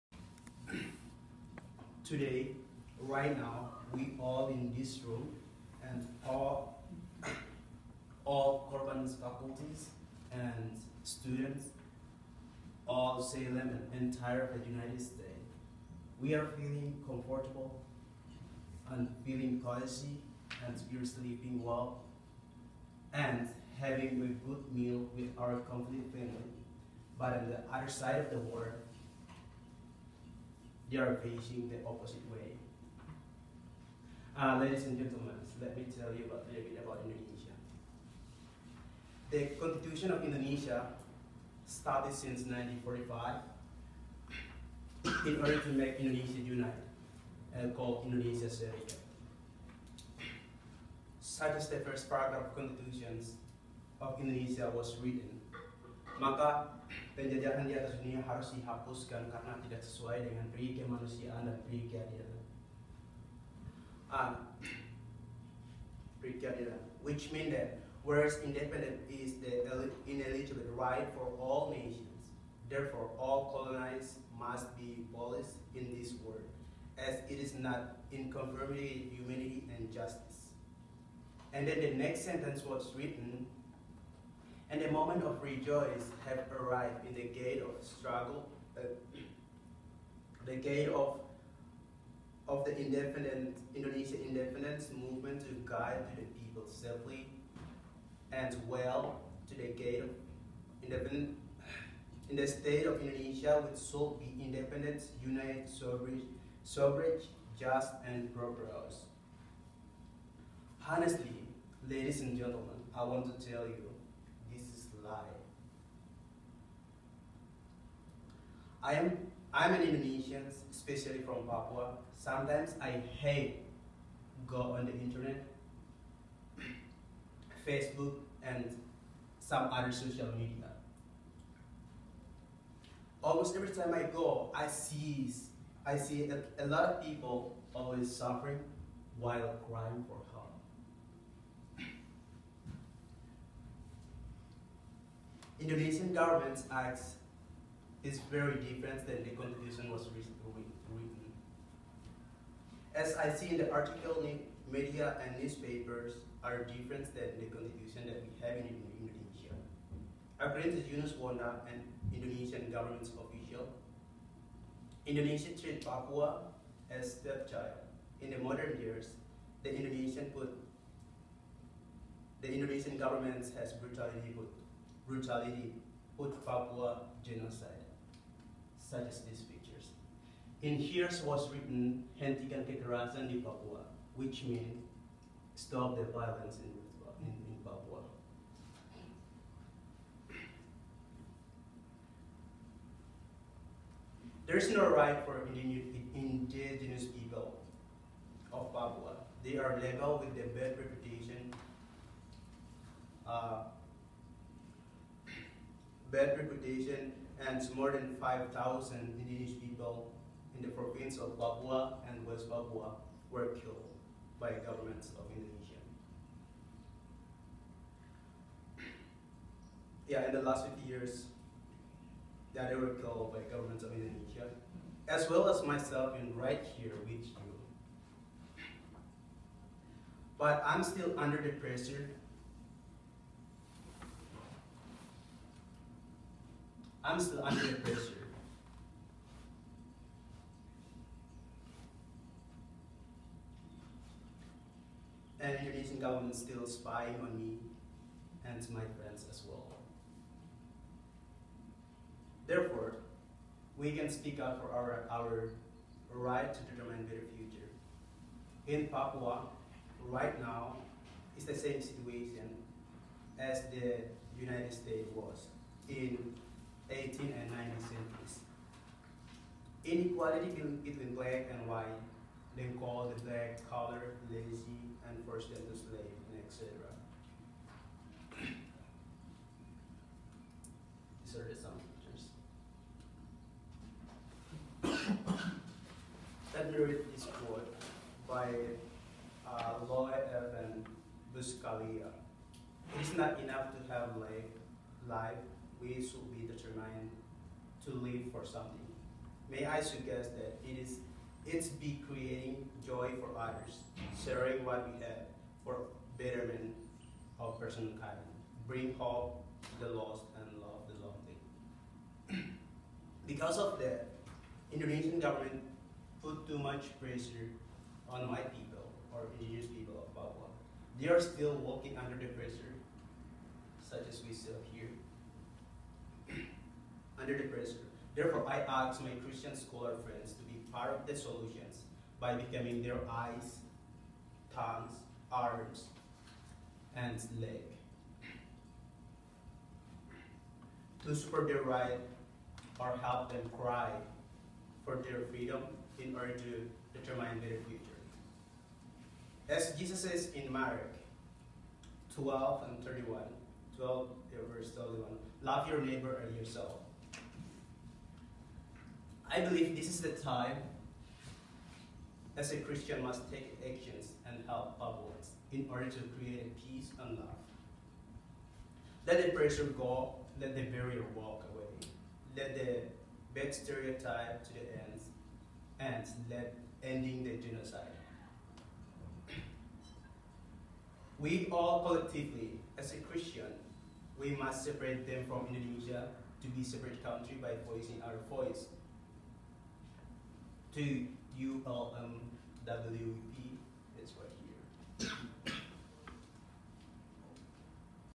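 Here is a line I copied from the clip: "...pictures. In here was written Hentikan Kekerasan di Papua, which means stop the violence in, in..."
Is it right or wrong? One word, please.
right.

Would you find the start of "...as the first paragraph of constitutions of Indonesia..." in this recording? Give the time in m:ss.
0:51.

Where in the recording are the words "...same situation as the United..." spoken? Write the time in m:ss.
4:21.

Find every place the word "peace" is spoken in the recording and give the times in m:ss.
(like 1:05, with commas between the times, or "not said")
6:06.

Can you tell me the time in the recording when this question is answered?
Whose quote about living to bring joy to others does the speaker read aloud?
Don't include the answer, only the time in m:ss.
4:49.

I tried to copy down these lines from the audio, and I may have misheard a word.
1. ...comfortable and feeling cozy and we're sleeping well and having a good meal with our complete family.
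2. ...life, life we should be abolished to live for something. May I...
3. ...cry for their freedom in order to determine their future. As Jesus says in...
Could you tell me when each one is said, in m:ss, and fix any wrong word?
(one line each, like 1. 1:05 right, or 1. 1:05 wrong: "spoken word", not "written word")
1. 0:17 right
2. 4:54 wrong: "determined", not "abolished"
3. 5:43 right.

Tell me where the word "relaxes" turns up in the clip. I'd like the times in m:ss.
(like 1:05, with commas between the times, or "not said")
not said.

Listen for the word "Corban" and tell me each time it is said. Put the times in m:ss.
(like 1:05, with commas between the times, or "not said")
0:08.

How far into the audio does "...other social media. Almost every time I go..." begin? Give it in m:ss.
2:09.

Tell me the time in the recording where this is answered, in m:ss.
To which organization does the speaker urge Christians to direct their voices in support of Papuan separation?
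6:31.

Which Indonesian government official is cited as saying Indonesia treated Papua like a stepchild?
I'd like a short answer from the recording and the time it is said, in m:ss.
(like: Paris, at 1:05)
Yunus Wanda, at 2:40.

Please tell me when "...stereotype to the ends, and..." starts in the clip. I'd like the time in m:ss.
6:13.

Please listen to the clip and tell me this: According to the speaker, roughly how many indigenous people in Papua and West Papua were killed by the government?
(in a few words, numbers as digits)
more than 5,000.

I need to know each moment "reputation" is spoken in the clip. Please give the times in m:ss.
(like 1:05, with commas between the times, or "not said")
3:20, 3:26.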